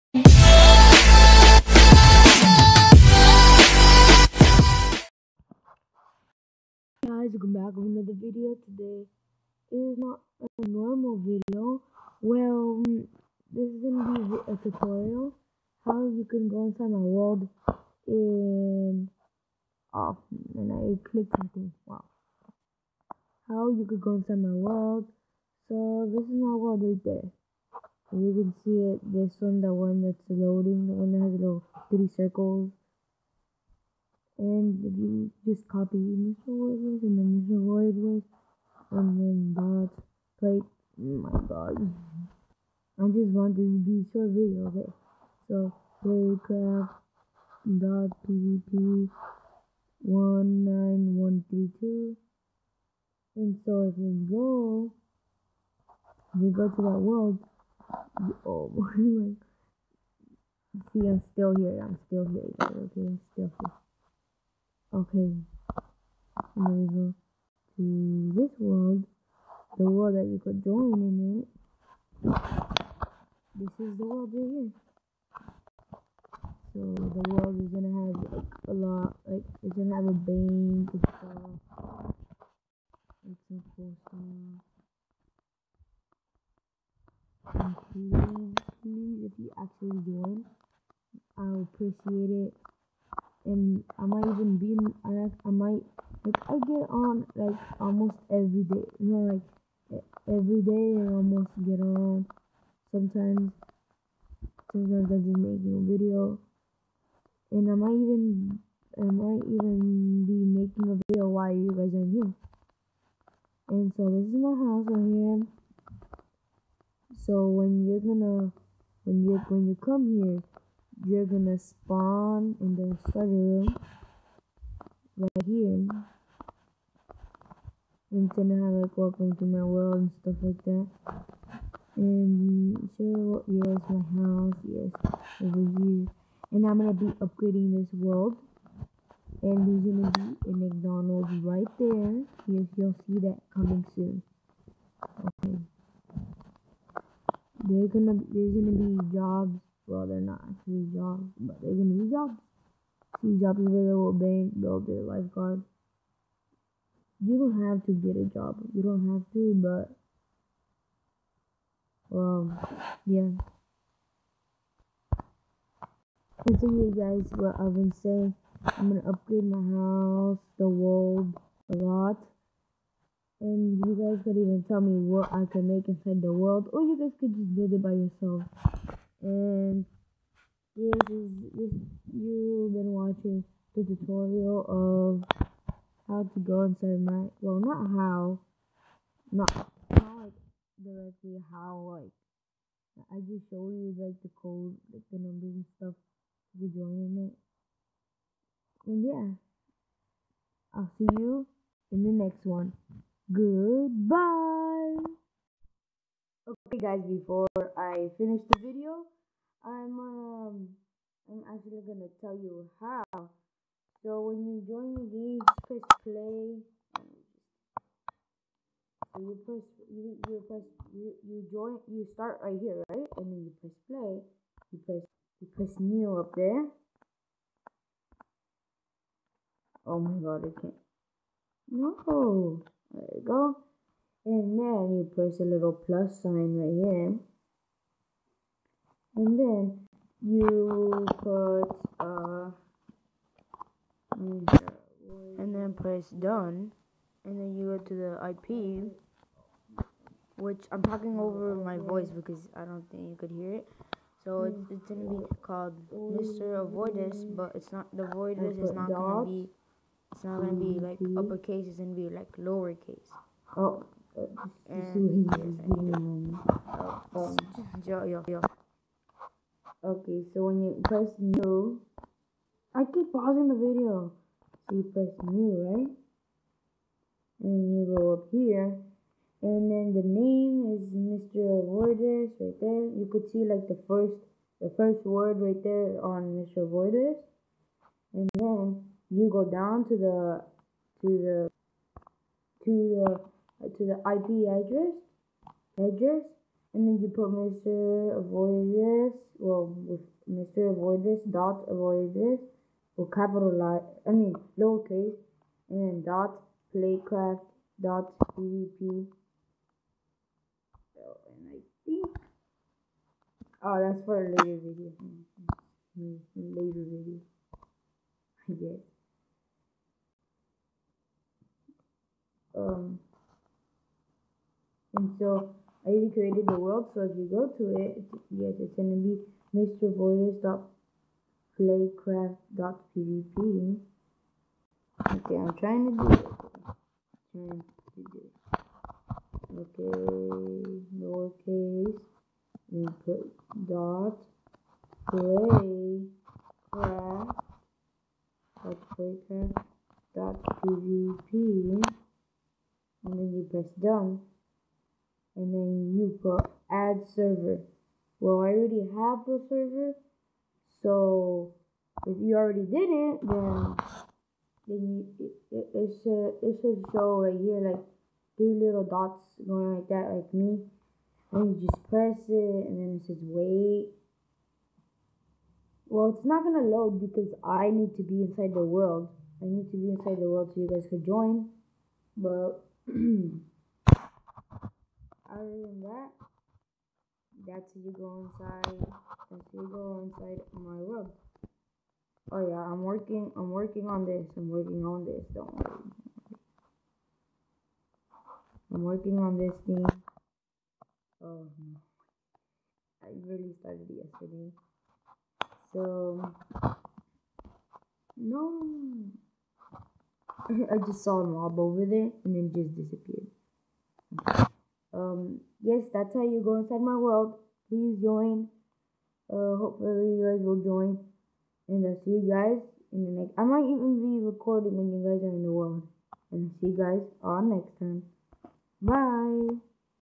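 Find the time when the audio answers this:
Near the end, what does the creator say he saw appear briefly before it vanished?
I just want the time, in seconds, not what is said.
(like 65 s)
411 s.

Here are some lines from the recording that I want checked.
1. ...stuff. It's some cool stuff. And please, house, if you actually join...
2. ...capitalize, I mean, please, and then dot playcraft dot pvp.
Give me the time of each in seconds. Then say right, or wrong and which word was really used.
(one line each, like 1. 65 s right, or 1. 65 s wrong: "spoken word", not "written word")
1. 80 s wrong: "please", not "house"
2. 303 s wrong: "lowercase", not "please".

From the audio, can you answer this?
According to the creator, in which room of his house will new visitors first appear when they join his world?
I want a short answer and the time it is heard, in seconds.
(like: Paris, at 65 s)
study room, at 123 s.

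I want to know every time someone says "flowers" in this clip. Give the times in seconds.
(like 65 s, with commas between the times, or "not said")
not said.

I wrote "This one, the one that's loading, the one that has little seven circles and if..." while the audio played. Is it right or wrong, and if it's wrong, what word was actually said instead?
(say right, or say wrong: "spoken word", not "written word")
wrong: "three", not "seven".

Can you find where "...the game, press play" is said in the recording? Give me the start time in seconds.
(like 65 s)
214 s.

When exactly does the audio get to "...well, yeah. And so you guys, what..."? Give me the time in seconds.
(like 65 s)
162 s.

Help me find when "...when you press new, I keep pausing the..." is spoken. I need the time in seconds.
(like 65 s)
270 s.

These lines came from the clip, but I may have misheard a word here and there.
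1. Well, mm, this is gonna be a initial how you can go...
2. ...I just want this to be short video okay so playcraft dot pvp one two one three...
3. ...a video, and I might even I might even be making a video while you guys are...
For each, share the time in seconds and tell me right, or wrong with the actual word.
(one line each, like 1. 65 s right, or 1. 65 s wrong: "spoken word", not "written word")
1. 12 s wrong: "tutorial", not "initial"
2. 42 s wrong: "nine", not "two"
3. 105 s right.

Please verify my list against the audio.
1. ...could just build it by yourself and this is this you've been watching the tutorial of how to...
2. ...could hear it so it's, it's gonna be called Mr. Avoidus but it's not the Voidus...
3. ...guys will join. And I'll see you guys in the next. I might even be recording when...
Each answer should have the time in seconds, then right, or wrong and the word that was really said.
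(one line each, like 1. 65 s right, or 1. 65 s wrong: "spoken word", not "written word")
1. 177 s right
2. 253 s right
3. 420 s right.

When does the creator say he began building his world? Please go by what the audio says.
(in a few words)
yesterday.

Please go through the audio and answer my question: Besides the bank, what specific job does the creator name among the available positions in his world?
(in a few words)
lifeguard.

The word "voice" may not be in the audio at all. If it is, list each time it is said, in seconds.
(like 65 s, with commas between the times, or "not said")
251 s.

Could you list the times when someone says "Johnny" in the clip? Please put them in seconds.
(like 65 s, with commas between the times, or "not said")
not said.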